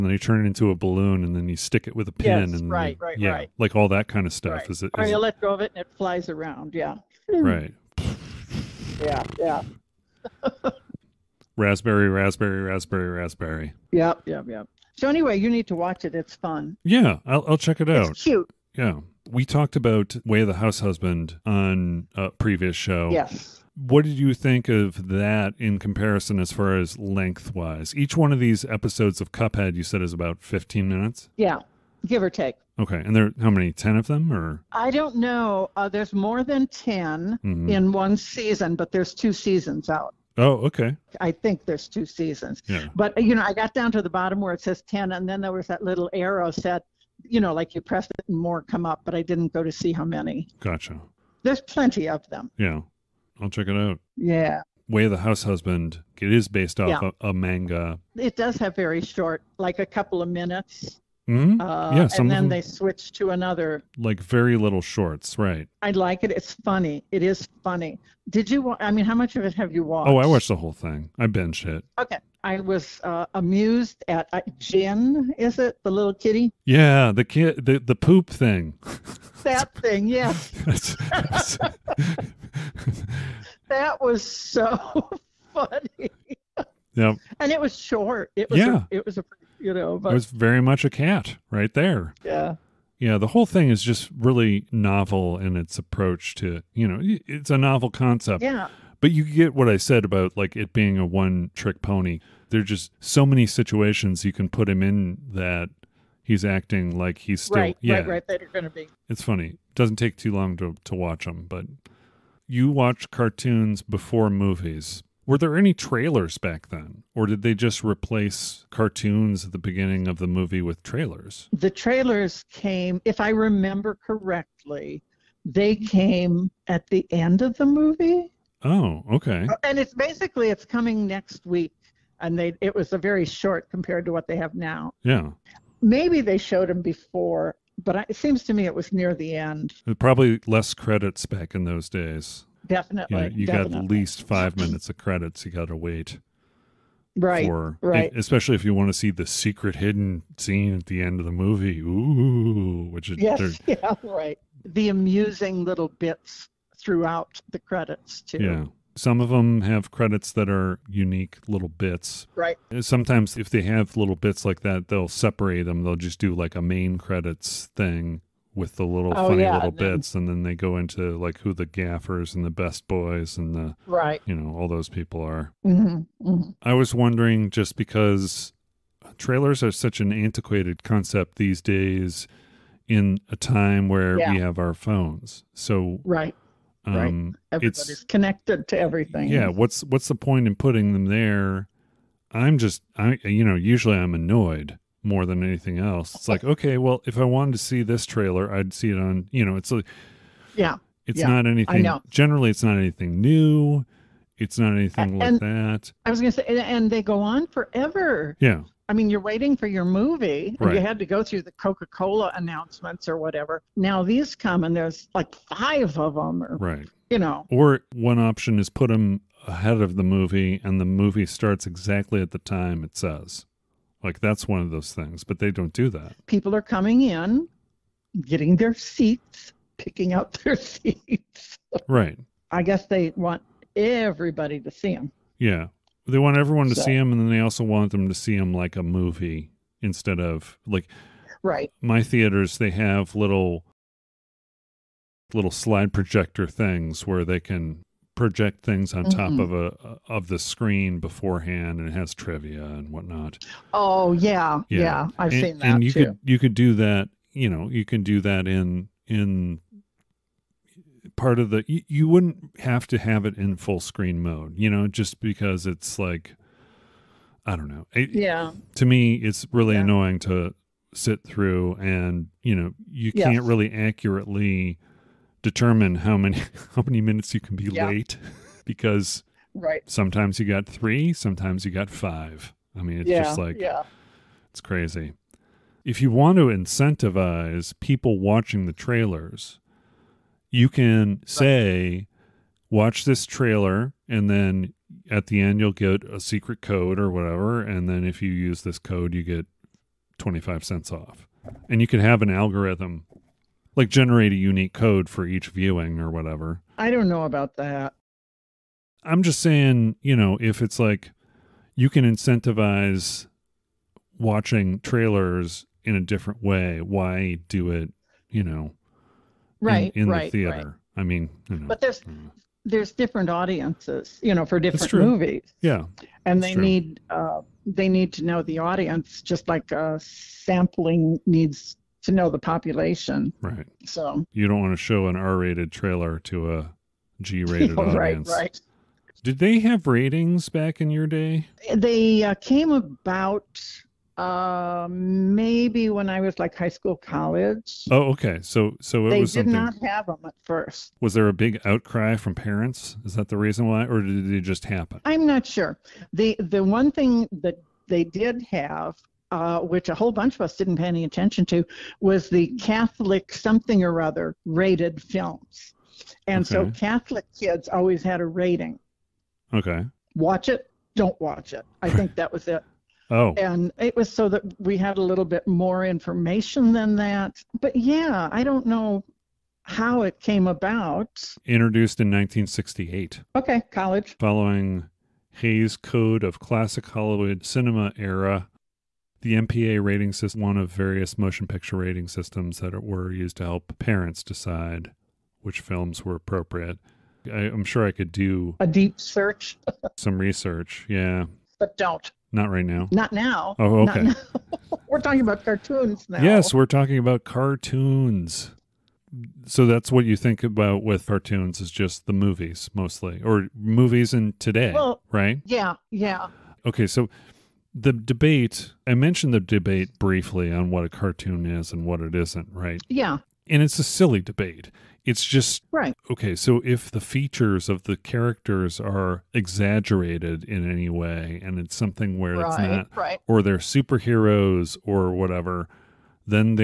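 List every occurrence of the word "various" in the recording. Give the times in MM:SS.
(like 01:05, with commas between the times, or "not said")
06:30.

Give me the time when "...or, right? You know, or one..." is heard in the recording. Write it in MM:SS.
03:36.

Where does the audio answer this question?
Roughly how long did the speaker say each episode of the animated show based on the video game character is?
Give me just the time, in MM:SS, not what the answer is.
00:30.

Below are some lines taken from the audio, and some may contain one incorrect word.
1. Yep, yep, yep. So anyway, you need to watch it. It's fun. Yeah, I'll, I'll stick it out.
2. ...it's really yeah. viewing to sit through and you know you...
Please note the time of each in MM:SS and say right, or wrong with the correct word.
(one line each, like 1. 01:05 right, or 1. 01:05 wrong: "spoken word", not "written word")
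1. 00:13 wrong: "check", not "stick"
2. 04:29 wrong: "annoying", not "viewing".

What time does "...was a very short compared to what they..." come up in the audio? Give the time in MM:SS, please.
02:12.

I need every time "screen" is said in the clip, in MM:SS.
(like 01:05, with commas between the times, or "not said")
04:10, 04:23.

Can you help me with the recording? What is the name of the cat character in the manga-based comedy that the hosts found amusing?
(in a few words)
Gin.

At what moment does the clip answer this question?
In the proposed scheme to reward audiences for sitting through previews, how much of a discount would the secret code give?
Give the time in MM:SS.
05:00.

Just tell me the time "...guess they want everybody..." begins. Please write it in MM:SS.
03:52.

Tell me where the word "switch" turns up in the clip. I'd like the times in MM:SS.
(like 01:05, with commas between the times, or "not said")
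01:02.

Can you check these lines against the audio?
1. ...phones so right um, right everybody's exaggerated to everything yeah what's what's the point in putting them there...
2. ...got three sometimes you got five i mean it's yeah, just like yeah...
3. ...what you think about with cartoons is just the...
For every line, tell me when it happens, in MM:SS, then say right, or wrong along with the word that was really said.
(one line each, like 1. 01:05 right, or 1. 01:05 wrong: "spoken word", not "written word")
1. 03:04 wrong: "connected", not "exaggerated"
2. 04:40 right
3. 06:49 right.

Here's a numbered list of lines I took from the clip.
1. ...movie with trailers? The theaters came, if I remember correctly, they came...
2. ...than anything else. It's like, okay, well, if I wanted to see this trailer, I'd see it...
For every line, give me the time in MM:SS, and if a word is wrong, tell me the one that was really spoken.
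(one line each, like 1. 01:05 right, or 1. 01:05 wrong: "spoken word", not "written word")
1. 02:00 wrong: "trailers", not "theaters"
2. 03:15 right.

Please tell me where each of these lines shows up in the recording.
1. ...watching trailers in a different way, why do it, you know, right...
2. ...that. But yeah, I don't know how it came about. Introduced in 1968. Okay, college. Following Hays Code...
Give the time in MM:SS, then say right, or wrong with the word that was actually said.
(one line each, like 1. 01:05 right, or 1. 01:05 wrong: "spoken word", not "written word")
1. 05:14 right
2. 06:16 right.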